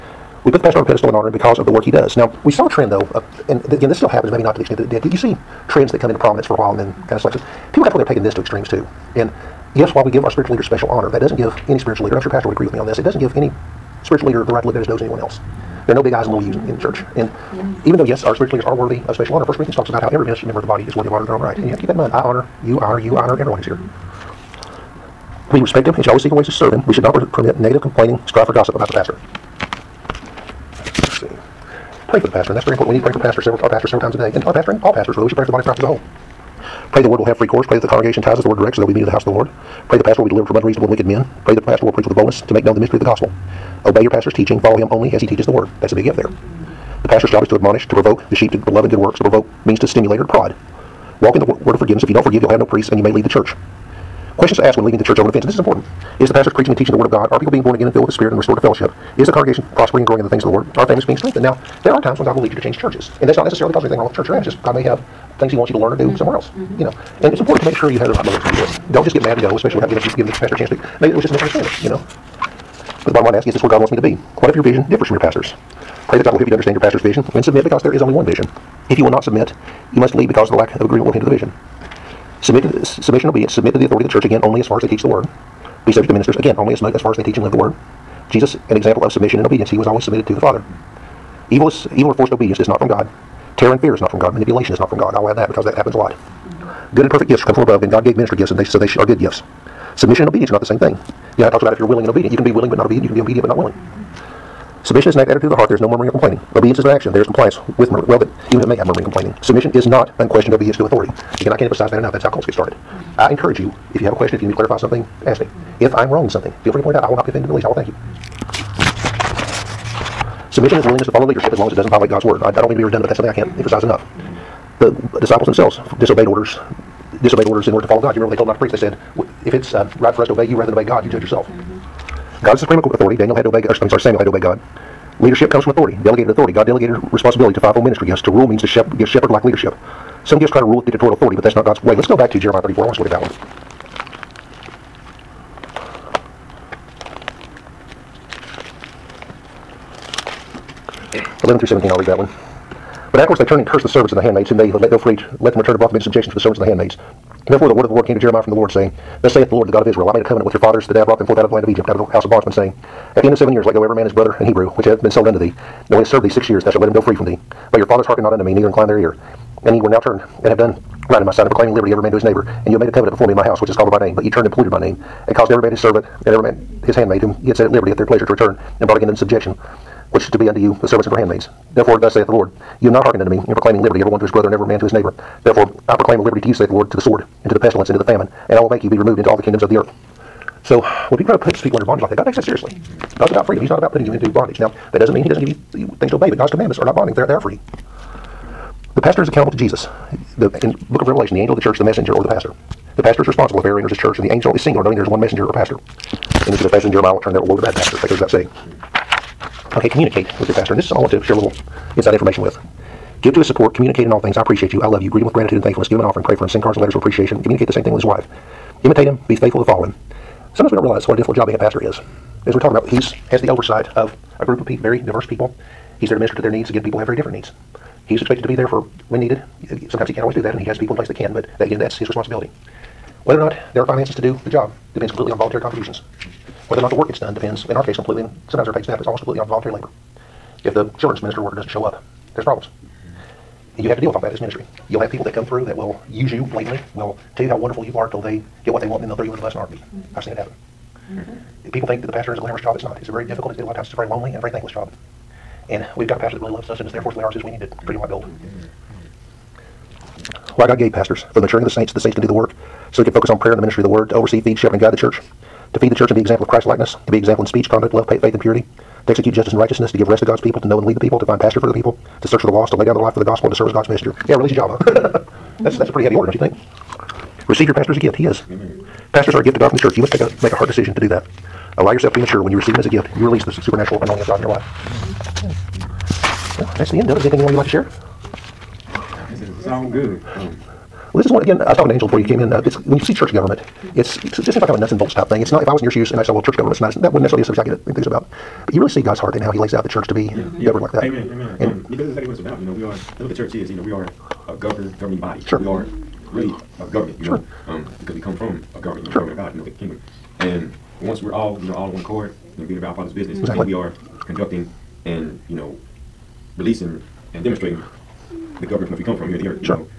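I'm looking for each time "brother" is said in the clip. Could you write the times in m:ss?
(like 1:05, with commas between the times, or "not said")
2:44, 3:04.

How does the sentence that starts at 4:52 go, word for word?
Uh, it's when you see church government it's it just seems like kind of a nuts and bolts type thing.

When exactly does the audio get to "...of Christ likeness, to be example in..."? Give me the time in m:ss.
4:26.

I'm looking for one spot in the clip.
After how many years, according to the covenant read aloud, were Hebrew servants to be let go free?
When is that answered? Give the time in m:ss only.
2:43.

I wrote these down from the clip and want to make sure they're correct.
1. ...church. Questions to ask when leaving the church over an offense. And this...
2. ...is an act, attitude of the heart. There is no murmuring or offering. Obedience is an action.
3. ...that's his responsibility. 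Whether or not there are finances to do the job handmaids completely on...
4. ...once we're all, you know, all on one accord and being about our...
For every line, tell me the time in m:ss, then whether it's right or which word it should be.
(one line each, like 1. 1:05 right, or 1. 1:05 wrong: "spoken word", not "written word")
1. 0:53 right
2. 1:45 wrong: "complaining", not "offering"
3. 3:51 wrong: "depends", not "handmaids"
4. 5:11 right.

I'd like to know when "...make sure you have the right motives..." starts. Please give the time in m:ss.
1:07.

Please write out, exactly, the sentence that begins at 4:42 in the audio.
When you receive them as a gift, you release the supernatural anointing of God in your life.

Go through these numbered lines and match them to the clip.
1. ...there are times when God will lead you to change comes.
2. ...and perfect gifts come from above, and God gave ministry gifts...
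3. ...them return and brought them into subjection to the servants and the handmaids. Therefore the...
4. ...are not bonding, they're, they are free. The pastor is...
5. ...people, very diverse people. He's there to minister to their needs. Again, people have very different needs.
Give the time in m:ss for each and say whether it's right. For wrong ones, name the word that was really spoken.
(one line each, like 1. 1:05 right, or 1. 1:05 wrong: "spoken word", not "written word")
1. 1:01 wrong: "churches", not "comes"
2. 1:37 right
3. 2:35 right
4. 3:16 right
5. 3:44 right.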